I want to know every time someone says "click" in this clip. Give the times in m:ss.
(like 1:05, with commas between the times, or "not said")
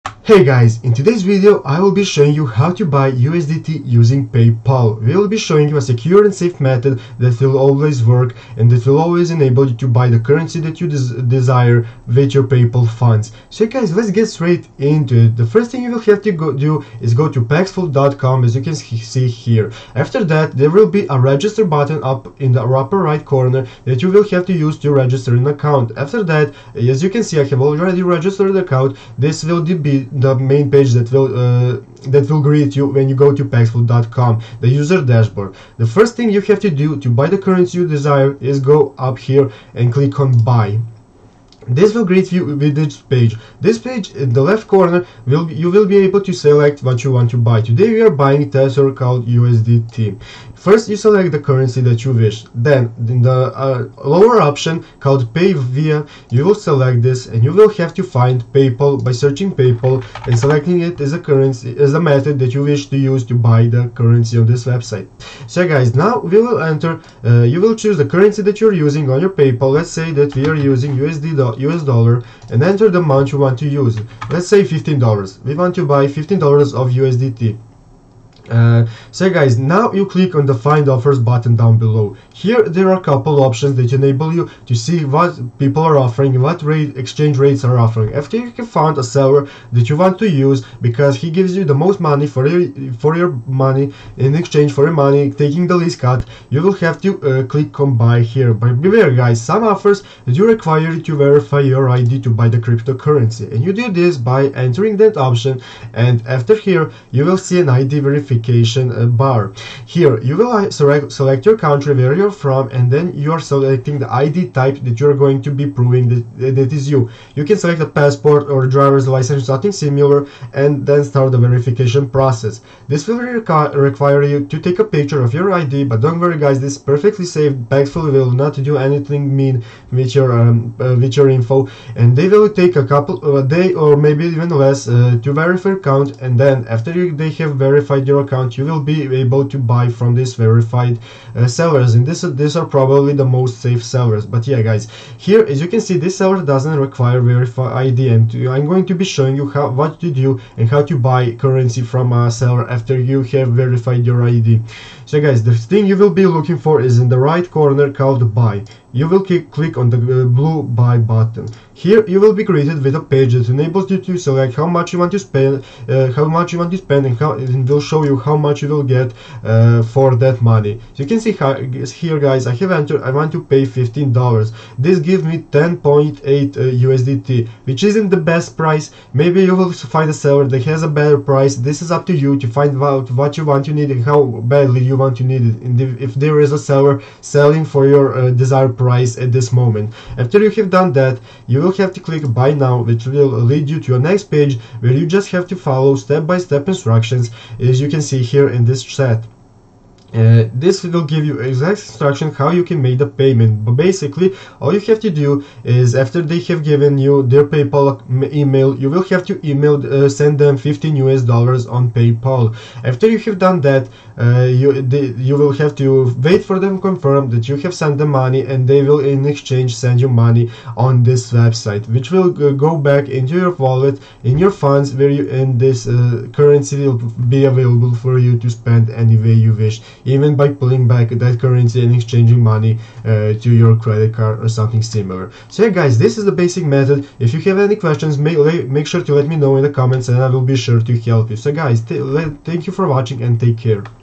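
0:39, 1:20, 1:37, 2:39, 3:12.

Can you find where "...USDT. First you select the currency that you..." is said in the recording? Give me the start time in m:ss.
0:49.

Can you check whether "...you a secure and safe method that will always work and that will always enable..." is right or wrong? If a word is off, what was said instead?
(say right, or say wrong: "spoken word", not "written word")
right.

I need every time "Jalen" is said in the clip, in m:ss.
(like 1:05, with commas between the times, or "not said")
not said.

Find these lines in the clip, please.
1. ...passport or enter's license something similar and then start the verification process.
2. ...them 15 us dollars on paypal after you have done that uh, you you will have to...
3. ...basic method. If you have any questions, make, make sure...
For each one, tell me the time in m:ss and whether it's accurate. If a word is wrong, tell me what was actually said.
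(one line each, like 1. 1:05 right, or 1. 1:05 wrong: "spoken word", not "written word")
1. 1:57 wrong: "driver", not "enter"
2. 3:30 right
3. 3:56 right.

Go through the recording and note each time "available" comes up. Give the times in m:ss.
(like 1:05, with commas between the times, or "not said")
3:47.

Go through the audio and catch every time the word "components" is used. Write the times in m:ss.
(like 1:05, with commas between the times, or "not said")
not said.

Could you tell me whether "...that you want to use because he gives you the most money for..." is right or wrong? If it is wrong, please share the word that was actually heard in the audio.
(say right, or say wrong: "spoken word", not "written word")
right.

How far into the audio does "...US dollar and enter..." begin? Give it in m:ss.
1:11.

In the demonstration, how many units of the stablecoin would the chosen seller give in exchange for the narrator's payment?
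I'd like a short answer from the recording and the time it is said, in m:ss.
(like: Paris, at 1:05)
10.8 USDT, at 2:55.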